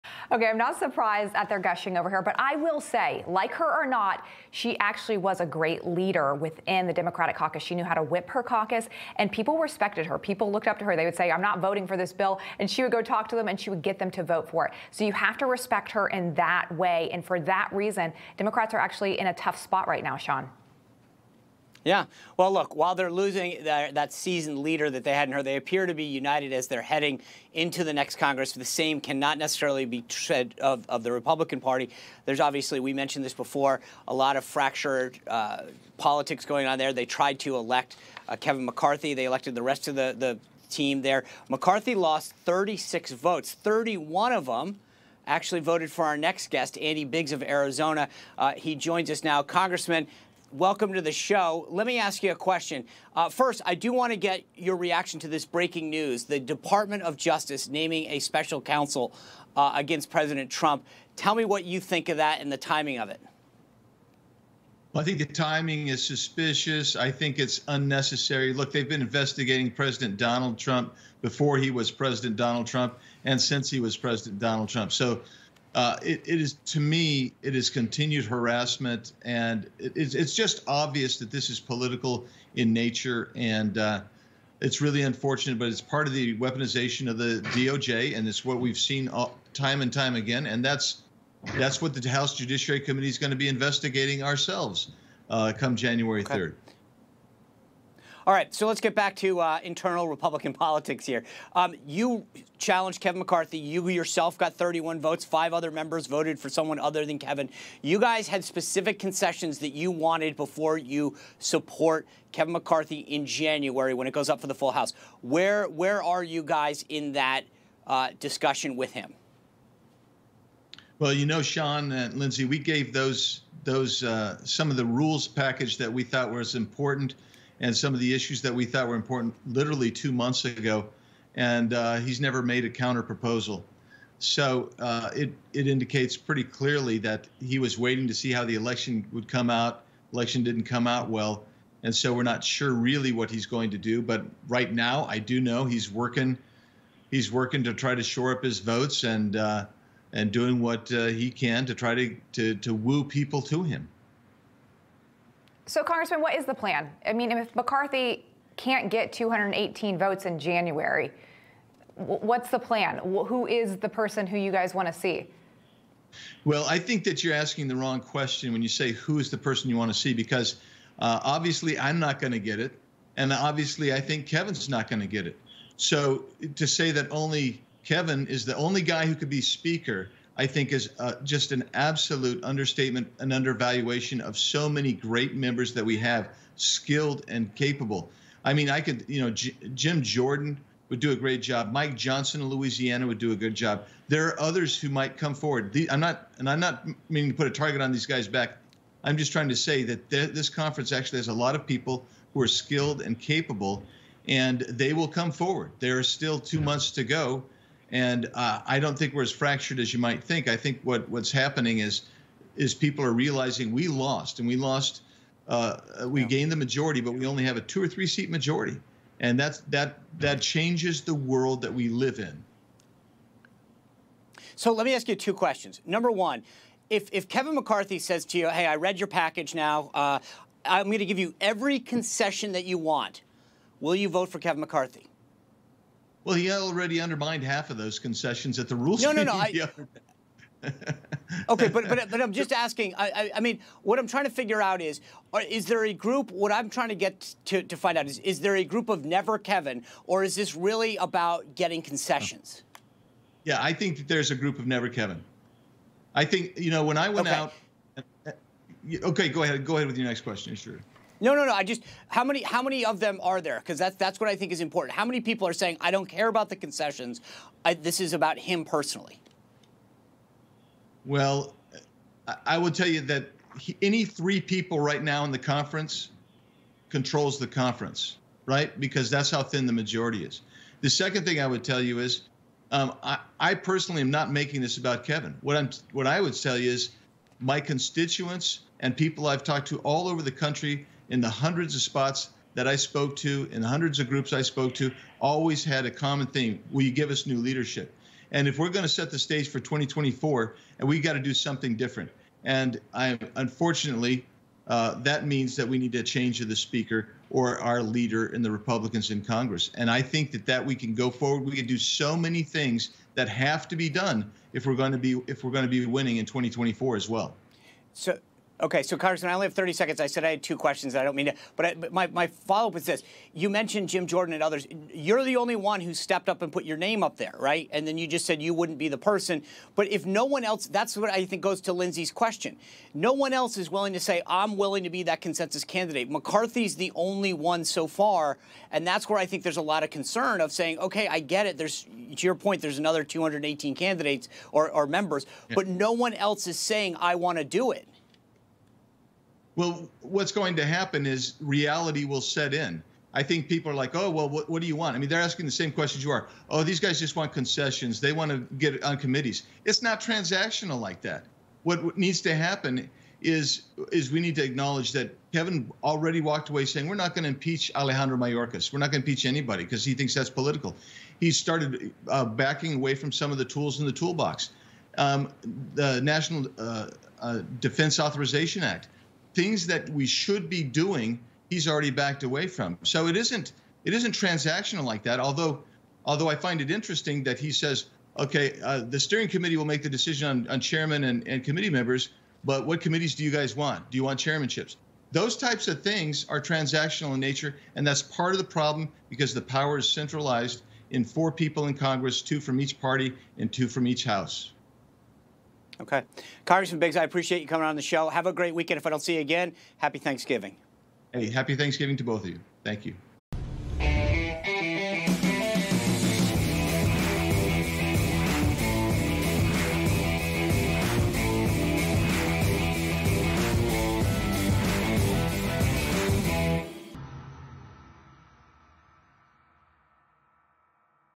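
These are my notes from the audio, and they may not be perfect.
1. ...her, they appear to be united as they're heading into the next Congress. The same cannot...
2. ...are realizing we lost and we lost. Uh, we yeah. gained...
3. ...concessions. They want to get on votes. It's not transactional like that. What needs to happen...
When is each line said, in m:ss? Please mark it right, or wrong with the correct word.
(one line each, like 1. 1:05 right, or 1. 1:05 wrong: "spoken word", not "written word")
1. 0:25 right
2. 3:33 right
3. 5:57 wrong: "committees", not "votes".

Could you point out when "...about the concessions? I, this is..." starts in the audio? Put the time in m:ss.
4:26.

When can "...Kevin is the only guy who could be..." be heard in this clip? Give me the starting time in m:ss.
2:57.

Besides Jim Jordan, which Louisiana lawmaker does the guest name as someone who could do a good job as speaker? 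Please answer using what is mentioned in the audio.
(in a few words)
Mike Johnson.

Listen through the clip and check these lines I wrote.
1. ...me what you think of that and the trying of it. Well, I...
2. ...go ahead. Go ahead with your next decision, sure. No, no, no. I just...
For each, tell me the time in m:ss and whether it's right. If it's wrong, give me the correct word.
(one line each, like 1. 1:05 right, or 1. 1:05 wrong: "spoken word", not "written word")
1. 1:01 wrong: "timing", not "trying"
2. 4:19 wrong: "question", not "decision".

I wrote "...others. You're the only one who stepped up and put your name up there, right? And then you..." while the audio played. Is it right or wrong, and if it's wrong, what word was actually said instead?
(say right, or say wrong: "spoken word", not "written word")
right.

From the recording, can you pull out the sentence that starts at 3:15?
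The, I'm not, and I'm not meaning to put a target on these guys' back.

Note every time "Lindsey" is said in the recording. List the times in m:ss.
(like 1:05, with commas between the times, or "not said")
2:02, 5:31.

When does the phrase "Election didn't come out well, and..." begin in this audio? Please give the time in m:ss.
2:20.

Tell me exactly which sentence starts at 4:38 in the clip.
Because that's how thin the majority is.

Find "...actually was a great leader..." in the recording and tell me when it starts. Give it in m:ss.
0:04.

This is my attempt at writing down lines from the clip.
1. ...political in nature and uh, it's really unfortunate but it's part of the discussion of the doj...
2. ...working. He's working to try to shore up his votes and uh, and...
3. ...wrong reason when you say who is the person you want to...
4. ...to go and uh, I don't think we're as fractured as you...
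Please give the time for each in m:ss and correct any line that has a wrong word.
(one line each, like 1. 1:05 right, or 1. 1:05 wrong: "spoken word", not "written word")
1. 1:21 wrong: "weaponization", not "discussion"
2. 2:25 right
3. 2:47 wrong: "question", not "reason"
4. 3:26 right.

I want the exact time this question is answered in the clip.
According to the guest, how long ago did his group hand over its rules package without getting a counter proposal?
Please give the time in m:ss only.
2:09.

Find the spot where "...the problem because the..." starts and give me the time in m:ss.
6:38.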